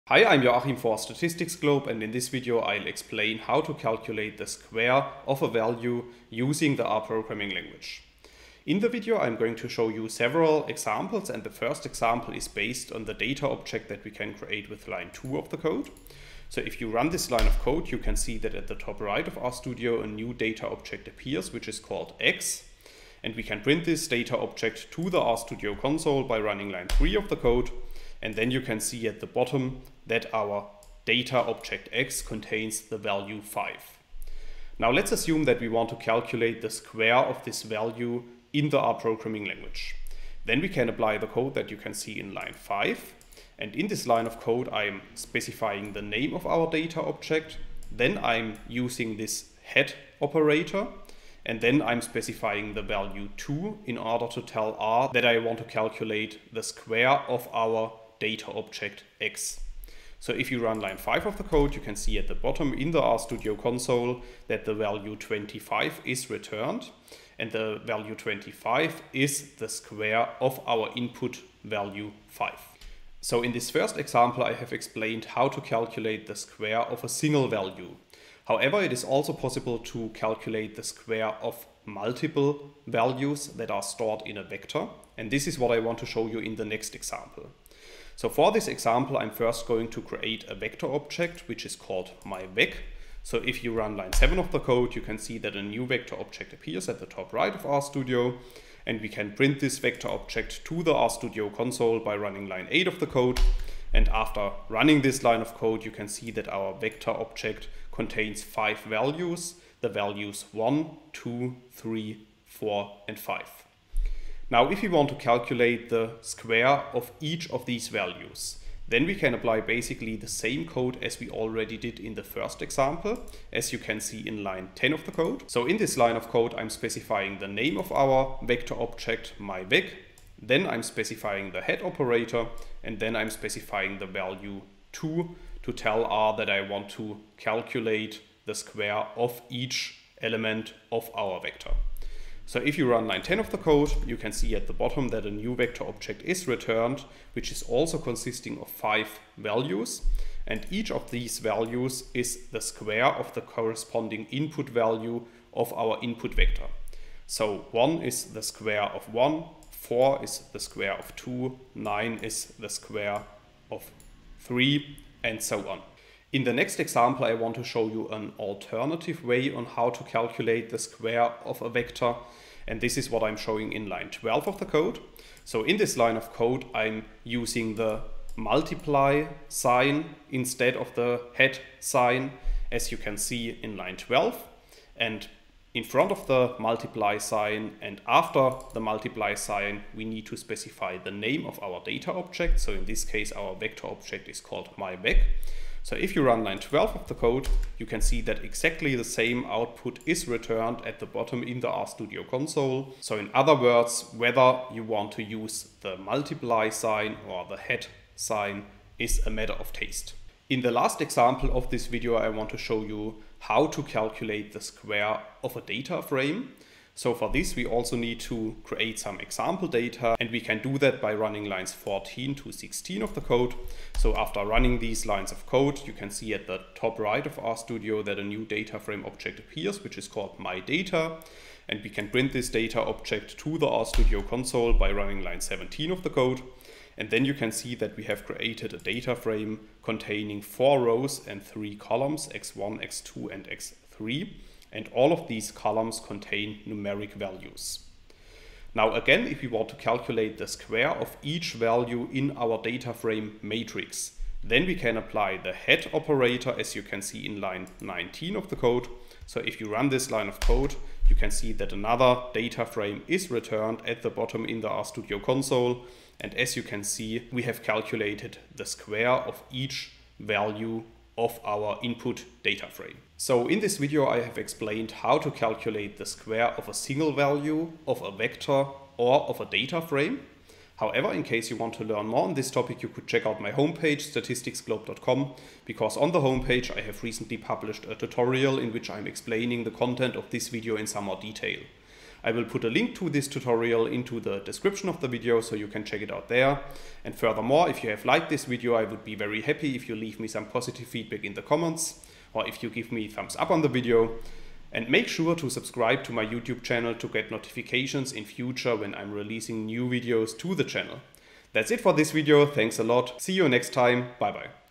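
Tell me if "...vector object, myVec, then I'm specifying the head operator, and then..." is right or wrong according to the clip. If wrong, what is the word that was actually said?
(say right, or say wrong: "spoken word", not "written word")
right.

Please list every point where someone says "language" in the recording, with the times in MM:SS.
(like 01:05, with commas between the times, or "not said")
00:07, 00:39.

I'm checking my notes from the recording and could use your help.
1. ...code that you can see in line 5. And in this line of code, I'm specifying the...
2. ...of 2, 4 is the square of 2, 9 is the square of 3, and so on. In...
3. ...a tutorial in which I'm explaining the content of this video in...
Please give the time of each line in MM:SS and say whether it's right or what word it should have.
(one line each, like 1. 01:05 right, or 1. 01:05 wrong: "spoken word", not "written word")
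1. 00:41 right
2. 02:38 wrong: "1", not "2"
3. 04:47 right.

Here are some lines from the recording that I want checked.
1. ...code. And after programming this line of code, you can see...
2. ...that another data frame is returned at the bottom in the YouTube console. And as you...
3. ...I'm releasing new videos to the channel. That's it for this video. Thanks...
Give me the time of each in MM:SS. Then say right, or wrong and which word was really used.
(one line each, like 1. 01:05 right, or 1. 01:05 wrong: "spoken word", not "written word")
1. 01:43 wrong: "running", not "programming"
2. 04:21 wrong: "RStudio", not "YouTube"
3. 05:08 right.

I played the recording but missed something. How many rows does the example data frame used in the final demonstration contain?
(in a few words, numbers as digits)
4.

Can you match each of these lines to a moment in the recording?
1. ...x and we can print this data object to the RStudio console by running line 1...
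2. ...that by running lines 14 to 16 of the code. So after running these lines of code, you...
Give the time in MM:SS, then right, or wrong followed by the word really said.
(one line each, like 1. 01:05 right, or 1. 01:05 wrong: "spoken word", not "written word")
1. 00:22 wrong: "3", not "1"
2. 03:40 right.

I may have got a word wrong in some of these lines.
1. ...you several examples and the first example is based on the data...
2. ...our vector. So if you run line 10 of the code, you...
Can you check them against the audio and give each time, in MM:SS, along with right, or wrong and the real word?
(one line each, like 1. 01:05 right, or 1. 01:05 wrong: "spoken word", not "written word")
1. 00:09 right
2. 02:21 right.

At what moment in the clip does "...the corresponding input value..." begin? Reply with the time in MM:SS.
02:33.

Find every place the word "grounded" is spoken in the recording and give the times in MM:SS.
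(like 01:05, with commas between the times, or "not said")
not said.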